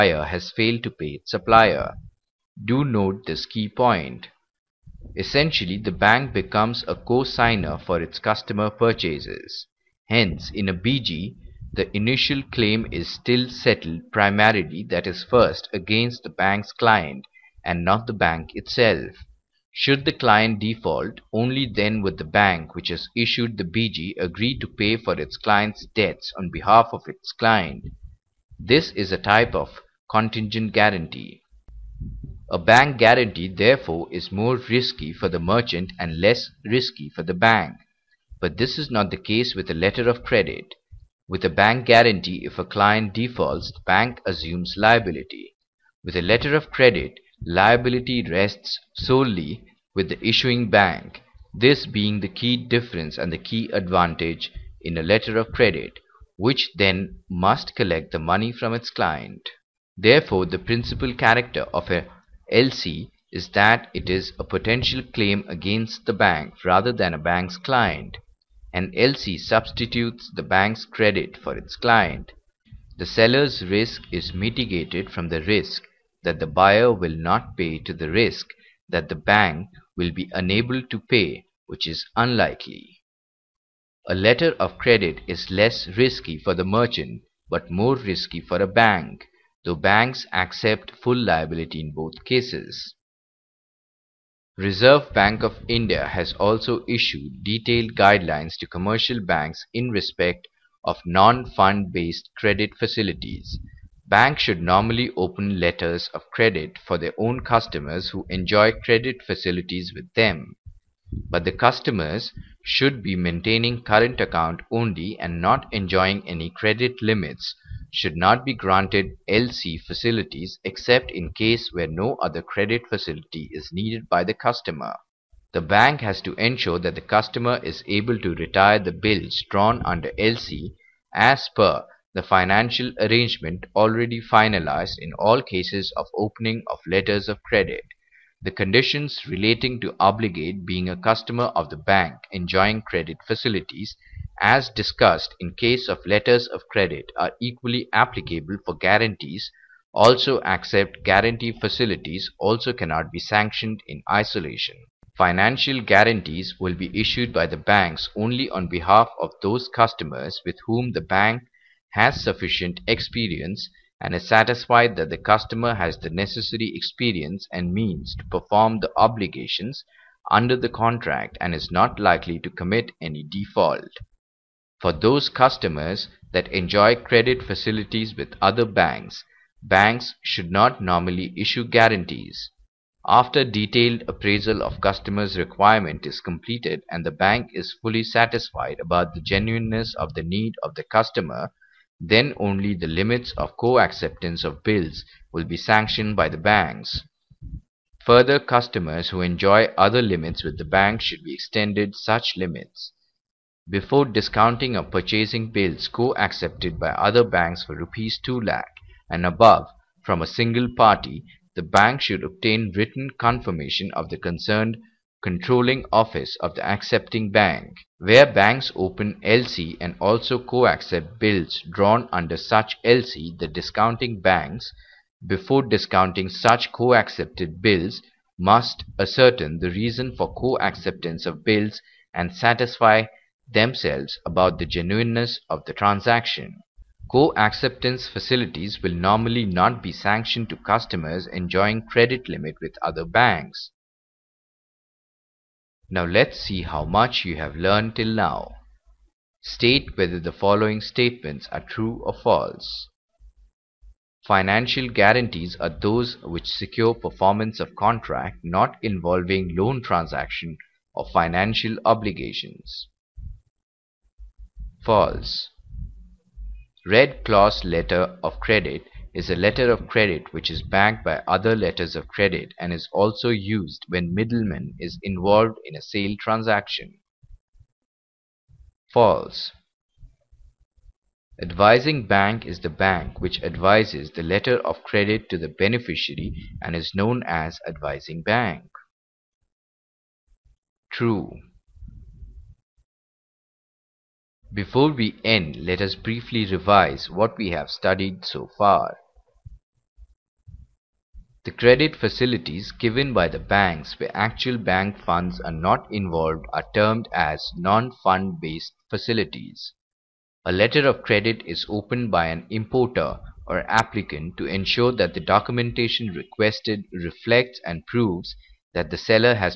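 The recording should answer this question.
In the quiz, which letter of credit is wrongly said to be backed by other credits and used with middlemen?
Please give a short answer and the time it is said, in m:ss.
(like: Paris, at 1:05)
Red clause letter of credit, at 4:26.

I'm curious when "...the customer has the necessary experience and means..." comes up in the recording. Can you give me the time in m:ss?
2:45.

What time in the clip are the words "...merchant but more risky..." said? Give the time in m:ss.
1:26.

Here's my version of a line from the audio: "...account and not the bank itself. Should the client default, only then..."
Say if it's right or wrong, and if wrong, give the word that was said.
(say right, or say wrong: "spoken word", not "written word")
wrong: "client", not "account".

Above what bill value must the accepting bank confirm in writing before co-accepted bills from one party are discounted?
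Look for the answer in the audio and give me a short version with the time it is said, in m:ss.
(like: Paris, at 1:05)
Rupees 2 lakh, at 3:27.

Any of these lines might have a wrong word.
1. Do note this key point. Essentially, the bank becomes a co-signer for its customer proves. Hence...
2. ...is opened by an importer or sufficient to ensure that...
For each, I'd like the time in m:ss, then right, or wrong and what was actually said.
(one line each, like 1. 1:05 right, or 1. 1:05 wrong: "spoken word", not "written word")
1. 0:02 wrong: "purchases", not "proves"
2. 5:11 wrong: "applicant", not "sufficient".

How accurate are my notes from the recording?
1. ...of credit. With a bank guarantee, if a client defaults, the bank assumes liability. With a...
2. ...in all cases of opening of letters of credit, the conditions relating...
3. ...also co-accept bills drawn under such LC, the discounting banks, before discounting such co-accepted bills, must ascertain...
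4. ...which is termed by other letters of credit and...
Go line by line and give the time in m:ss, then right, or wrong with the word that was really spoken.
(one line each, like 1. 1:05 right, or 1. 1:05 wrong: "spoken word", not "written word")
1. 0:40 right
2. 2:14 right
3. 3:39 right
4. 4:30 wrong: "backed", not "termed".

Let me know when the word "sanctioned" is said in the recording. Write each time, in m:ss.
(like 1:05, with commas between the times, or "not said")
2:33, 3:15, 3:59.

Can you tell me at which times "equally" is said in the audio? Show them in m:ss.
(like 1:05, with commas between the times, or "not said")
2:27.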